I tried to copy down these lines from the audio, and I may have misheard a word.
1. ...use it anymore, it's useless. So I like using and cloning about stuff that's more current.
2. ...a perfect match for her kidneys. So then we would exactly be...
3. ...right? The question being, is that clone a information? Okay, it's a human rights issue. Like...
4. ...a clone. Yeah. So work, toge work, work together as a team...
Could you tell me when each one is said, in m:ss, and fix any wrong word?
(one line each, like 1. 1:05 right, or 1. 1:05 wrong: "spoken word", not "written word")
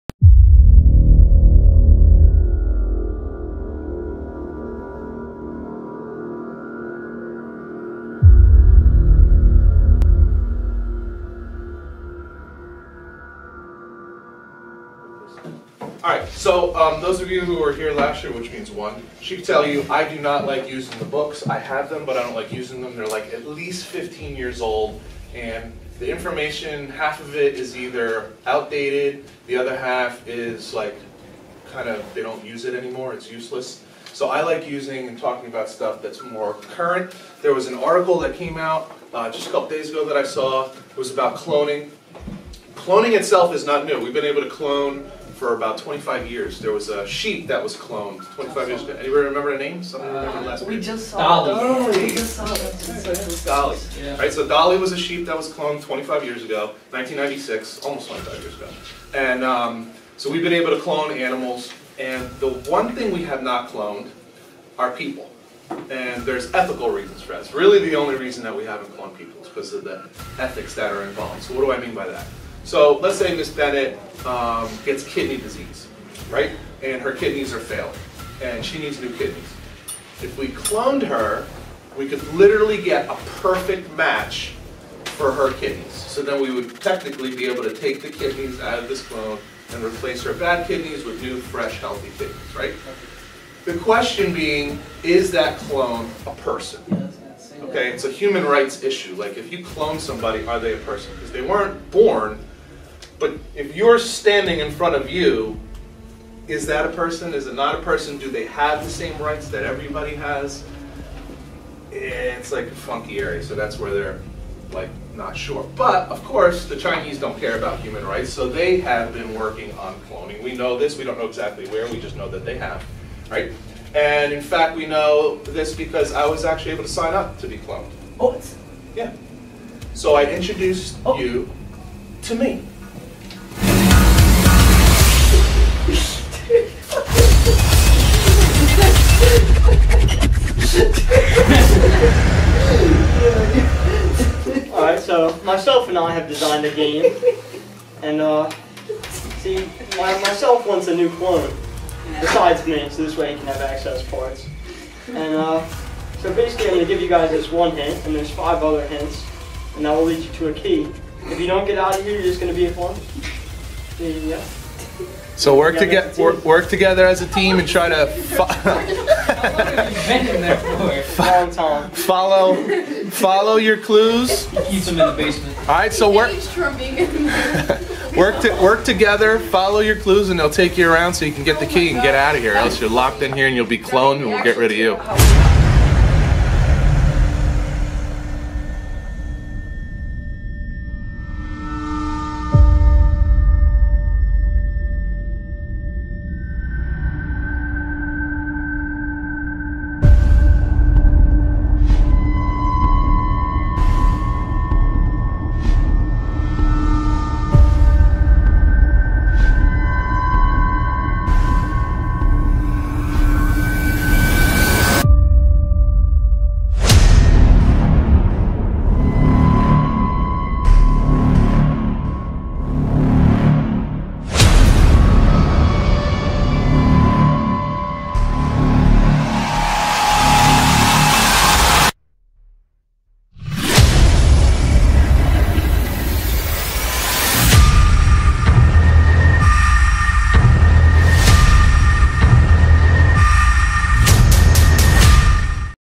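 1. 0:32 wrong: "talking", not "cloning"
2. 1:23 wrong: "technically", not "exactly"
3. 1:32 wrong: "person", not "information"
4. 2:42 right.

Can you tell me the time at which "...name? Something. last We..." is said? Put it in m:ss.
0:49.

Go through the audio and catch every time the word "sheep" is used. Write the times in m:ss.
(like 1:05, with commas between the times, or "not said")
0:47, 0:54.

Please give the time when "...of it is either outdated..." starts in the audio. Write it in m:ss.
0:27.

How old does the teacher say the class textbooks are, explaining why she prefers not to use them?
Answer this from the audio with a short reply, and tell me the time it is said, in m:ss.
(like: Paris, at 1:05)
at least 15 years, at 0:23.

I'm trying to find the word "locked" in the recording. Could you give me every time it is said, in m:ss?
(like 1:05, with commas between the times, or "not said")
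3:02.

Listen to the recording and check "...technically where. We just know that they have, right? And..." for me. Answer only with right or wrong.
wrong.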